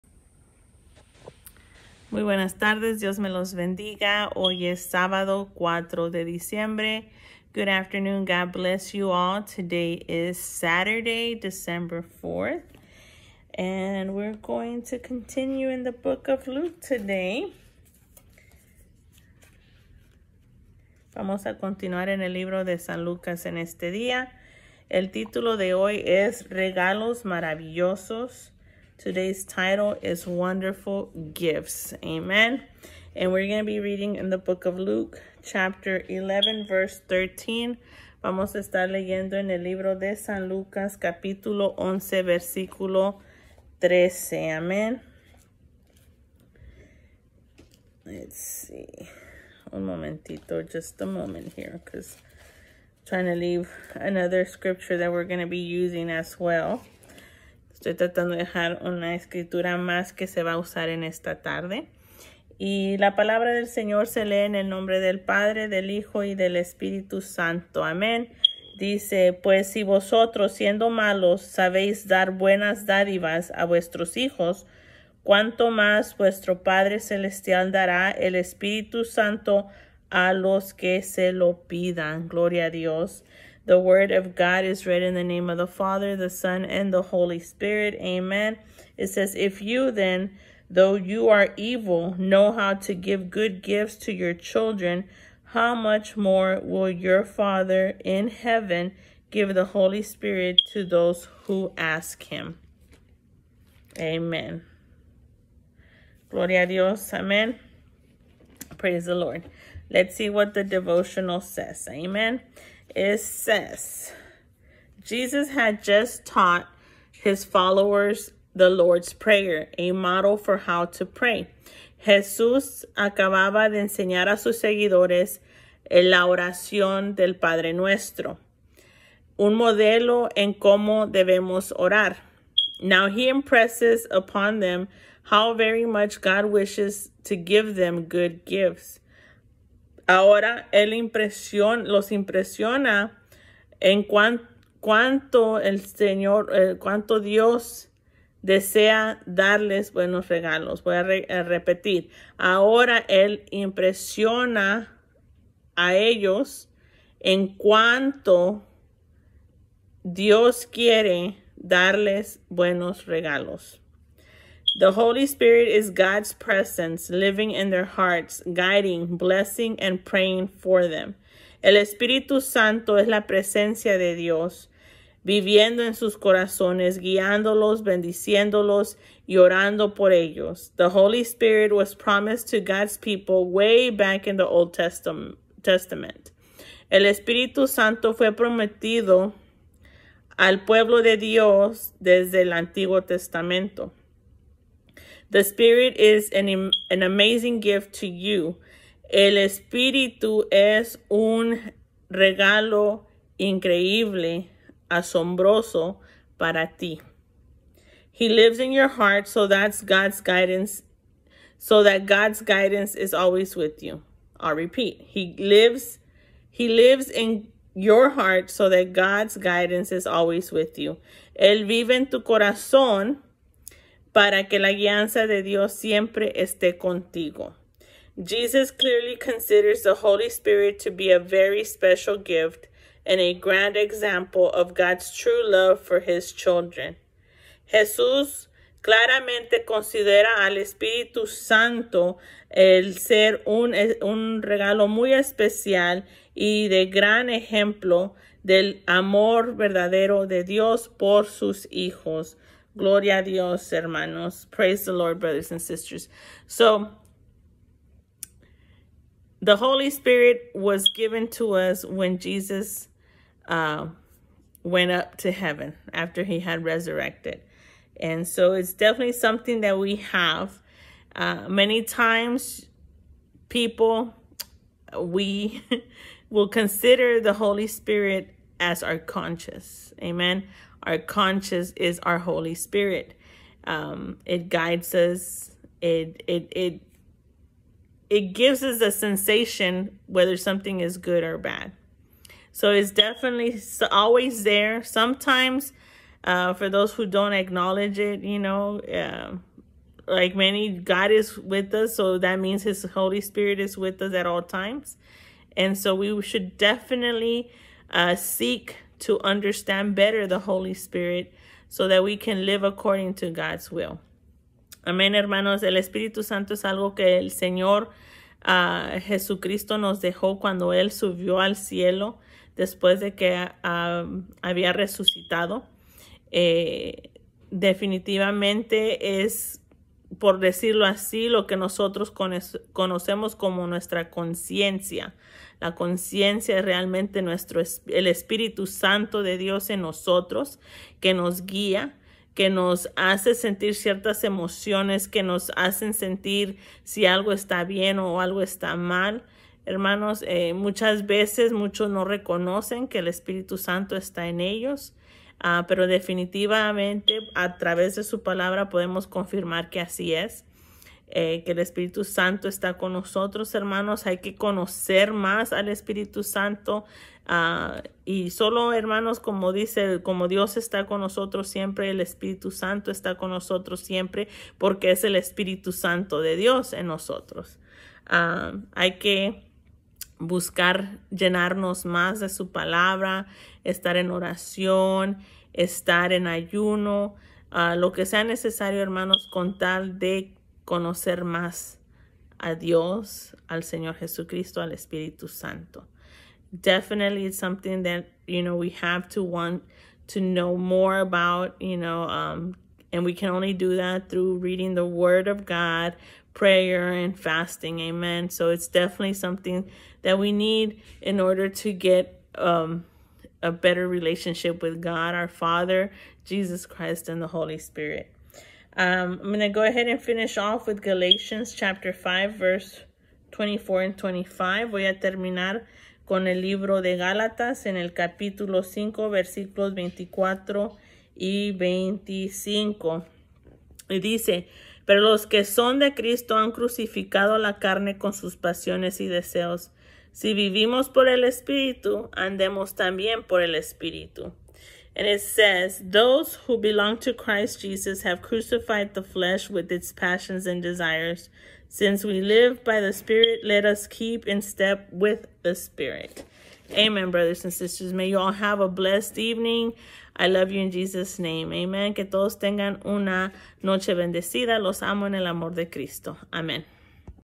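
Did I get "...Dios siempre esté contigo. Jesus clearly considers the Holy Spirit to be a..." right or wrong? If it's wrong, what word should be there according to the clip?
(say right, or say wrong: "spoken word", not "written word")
right.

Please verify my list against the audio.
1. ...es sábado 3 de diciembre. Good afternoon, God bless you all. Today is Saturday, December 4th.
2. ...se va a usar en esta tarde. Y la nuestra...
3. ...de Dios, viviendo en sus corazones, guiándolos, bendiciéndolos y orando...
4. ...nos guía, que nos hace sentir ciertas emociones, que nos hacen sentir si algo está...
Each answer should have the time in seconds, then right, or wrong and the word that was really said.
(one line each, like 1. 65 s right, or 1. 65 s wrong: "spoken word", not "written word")
1. 4 s wrong: "4", not "3"
2. 60 s wrong: "palabra", not "nuestra"
3. 173 s right
4. 341 s right.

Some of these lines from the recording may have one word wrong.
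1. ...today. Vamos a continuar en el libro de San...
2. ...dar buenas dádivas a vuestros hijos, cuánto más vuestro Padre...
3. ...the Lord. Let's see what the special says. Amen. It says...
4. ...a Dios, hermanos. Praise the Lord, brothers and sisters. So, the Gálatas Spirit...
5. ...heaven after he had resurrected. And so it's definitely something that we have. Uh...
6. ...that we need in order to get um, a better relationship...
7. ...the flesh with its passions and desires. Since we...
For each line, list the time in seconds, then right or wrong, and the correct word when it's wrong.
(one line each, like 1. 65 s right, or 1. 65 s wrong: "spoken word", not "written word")
1. 16 s right
2. 72 s right
3. 109 s wrong: "devotional", not "special"
4. 253 s wrong: "Holy", not "Gálatas"
5. 265 s right
6. 410 s right
7. 448 s right.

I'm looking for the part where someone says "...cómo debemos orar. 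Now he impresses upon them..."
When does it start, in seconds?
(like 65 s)
130 s.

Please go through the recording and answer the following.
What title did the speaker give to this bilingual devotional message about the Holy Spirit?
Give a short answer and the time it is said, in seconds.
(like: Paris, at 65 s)
Wonderful Gifts, at 30 s.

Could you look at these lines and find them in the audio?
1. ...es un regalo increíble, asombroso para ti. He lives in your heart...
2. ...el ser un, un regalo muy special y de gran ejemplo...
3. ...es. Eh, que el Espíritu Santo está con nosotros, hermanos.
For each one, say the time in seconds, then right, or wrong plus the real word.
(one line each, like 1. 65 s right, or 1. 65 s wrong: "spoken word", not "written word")
1. 200 s right
2. 242 s wrong: "especial", not "special"
3. 360 s right.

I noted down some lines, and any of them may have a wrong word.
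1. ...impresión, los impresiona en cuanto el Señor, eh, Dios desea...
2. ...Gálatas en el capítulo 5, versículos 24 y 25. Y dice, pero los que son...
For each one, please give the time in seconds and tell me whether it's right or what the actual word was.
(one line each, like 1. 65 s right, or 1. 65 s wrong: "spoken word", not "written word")
1. 140 s right
2. 426 s right.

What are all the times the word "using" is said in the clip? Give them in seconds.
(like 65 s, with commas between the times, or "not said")
55 s.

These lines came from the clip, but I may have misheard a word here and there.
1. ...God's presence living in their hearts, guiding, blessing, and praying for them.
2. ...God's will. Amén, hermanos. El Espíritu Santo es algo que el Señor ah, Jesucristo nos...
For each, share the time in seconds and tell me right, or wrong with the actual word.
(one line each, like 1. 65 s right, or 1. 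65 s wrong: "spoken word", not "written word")
1. 165 s right
2. 313 s right.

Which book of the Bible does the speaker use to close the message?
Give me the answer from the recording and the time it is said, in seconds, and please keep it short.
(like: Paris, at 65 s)
Galatians, at 420 s.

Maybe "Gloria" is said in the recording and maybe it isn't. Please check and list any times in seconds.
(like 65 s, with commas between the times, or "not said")
82 s, 106 s, 252 s.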